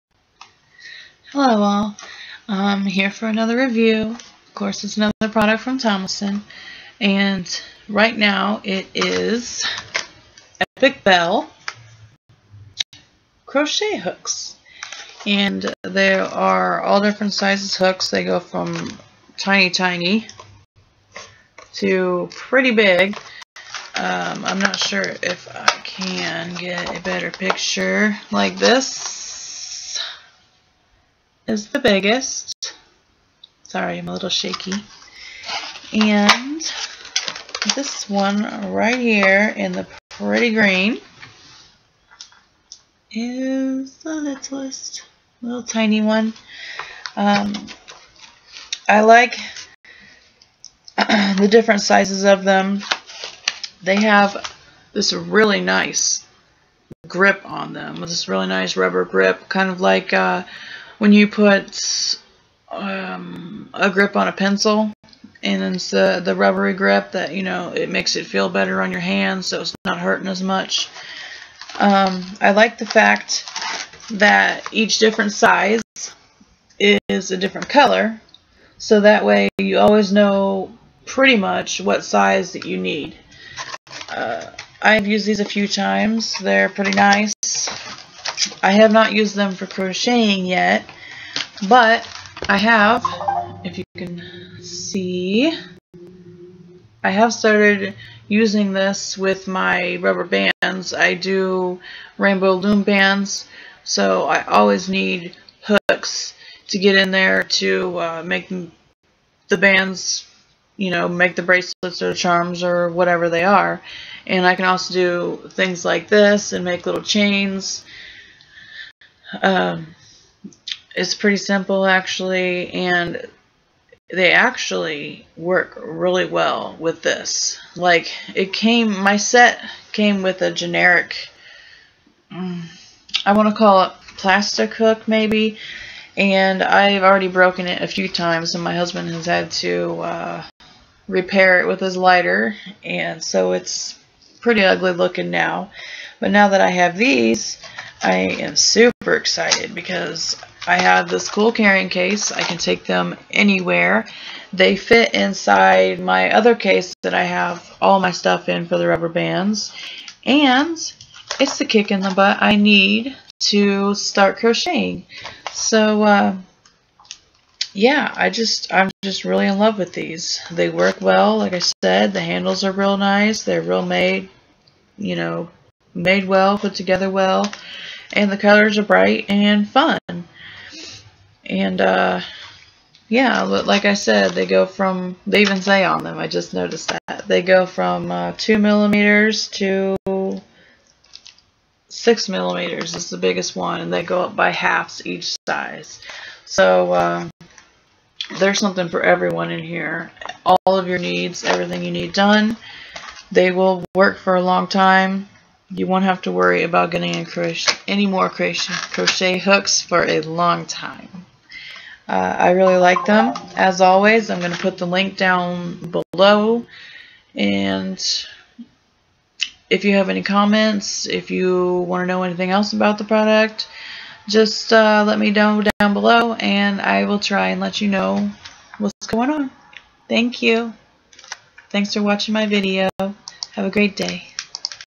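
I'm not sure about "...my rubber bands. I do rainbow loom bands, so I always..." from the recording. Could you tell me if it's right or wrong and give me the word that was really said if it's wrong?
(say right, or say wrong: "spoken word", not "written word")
right.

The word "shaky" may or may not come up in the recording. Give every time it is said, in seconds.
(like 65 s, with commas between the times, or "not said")
34 s.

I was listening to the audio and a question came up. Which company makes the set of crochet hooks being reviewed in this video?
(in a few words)
Thomason.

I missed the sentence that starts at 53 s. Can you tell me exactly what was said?
They have this really nice grip on them.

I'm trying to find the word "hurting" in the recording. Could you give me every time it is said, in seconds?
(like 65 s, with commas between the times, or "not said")
69 s.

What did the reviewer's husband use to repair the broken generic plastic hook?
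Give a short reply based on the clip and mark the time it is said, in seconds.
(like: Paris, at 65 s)
His lighter, at 141 s.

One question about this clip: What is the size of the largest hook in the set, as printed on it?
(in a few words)
6 millimeters.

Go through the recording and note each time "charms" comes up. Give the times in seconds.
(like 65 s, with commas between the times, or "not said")
112 s.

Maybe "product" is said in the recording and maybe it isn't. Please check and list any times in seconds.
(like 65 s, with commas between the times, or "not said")
5 s, 223 s.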